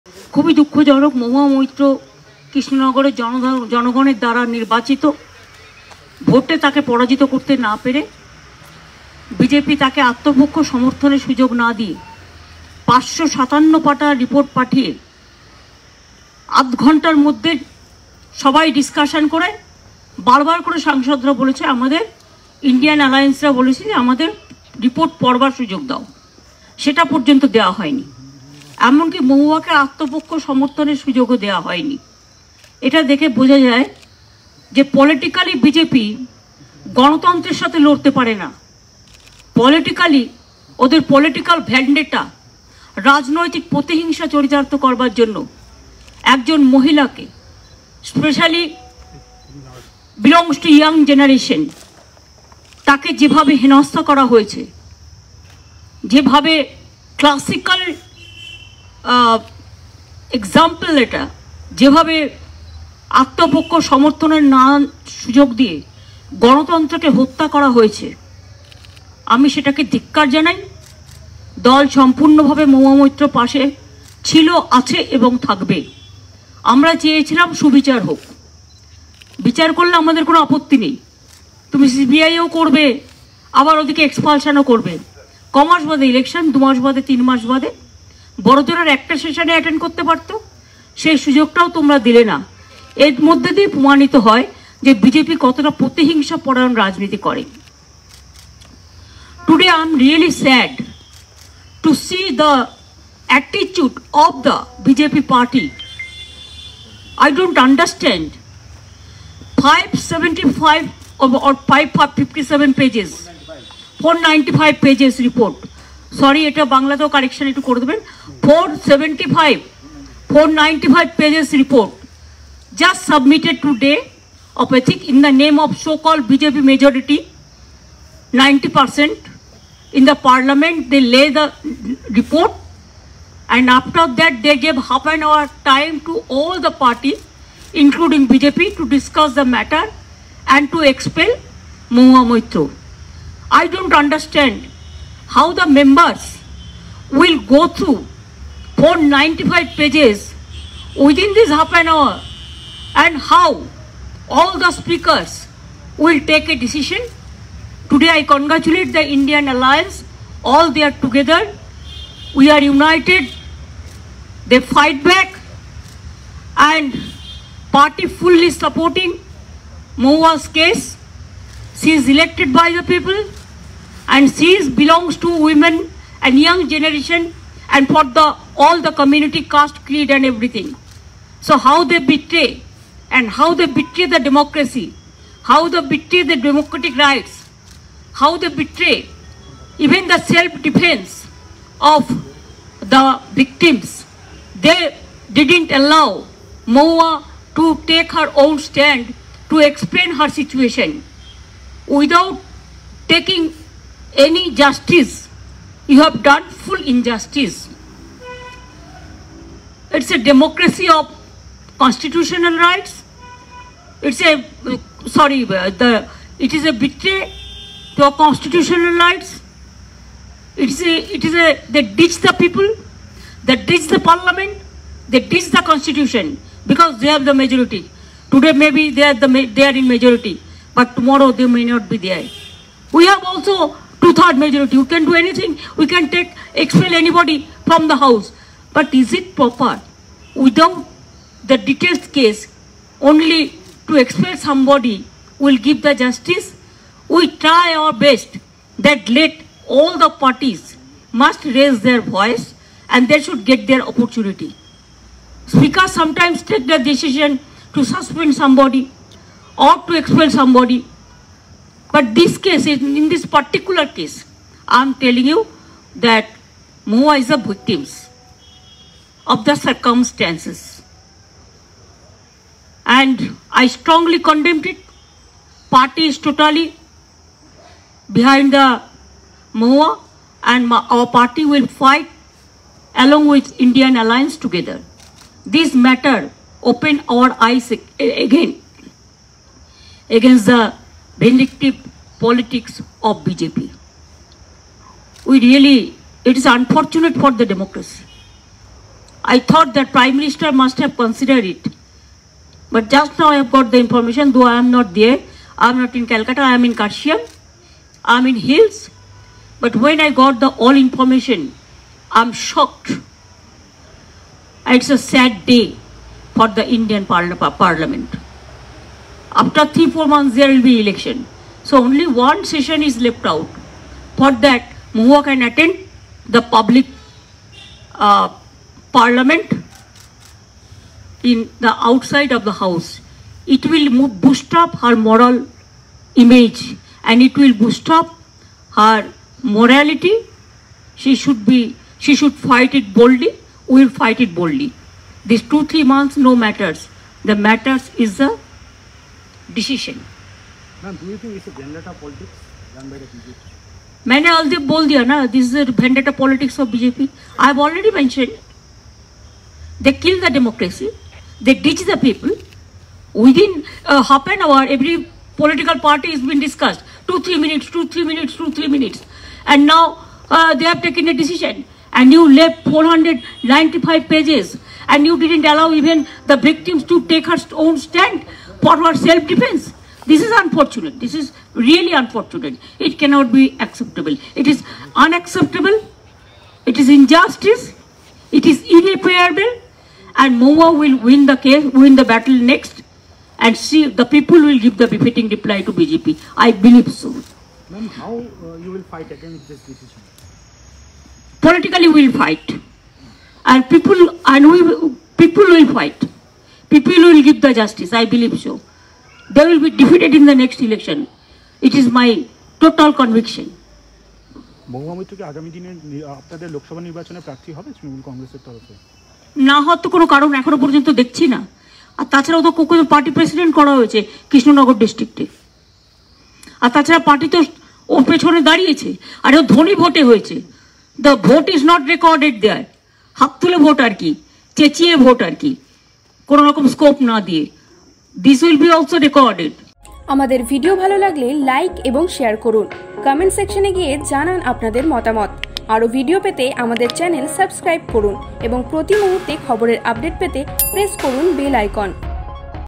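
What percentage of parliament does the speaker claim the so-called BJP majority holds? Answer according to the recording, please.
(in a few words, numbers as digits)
90%.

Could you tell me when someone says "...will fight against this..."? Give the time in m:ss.
6:38.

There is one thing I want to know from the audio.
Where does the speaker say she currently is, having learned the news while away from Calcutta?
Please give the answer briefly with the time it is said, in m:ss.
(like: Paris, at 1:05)
Kashmir, at 5:06.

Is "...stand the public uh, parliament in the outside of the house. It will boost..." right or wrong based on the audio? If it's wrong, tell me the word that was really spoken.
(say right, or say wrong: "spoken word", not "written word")
wrong: "attend", not "stand".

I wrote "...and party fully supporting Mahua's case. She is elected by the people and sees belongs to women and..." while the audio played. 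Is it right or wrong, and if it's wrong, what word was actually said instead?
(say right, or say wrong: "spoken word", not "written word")
right.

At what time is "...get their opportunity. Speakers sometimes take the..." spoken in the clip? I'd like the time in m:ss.
4:13.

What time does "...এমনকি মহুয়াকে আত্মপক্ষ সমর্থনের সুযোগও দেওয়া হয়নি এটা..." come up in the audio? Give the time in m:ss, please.
0:28.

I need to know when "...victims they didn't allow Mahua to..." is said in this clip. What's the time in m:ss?
3:13.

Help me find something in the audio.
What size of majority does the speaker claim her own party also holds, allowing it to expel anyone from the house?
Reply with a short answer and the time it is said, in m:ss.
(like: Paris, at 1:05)
two-third majority, at 3:54.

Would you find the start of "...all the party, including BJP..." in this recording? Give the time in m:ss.
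2:16.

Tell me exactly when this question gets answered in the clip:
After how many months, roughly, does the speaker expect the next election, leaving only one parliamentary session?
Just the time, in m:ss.
5:19.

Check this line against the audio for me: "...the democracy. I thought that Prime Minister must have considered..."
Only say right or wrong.
right.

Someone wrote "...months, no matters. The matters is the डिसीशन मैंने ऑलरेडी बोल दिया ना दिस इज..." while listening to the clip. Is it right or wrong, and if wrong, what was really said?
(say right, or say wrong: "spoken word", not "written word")
right.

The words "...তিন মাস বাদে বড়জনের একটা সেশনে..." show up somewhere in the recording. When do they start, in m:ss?
1:27.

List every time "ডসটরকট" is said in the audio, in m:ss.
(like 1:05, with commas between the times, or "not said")
7:04.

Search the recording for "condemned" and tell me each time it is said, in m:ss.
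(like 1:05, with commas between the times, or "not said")
4:34.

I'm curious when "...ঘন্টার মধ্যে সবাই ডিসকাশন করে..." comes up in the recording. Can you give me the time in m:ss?
0:16.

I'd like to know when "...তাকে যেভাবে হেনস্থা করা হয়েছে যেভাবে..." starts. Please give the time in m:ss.
0:52.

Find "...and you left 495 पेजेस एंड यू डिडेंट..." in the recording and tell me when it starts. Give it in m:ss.
6:11.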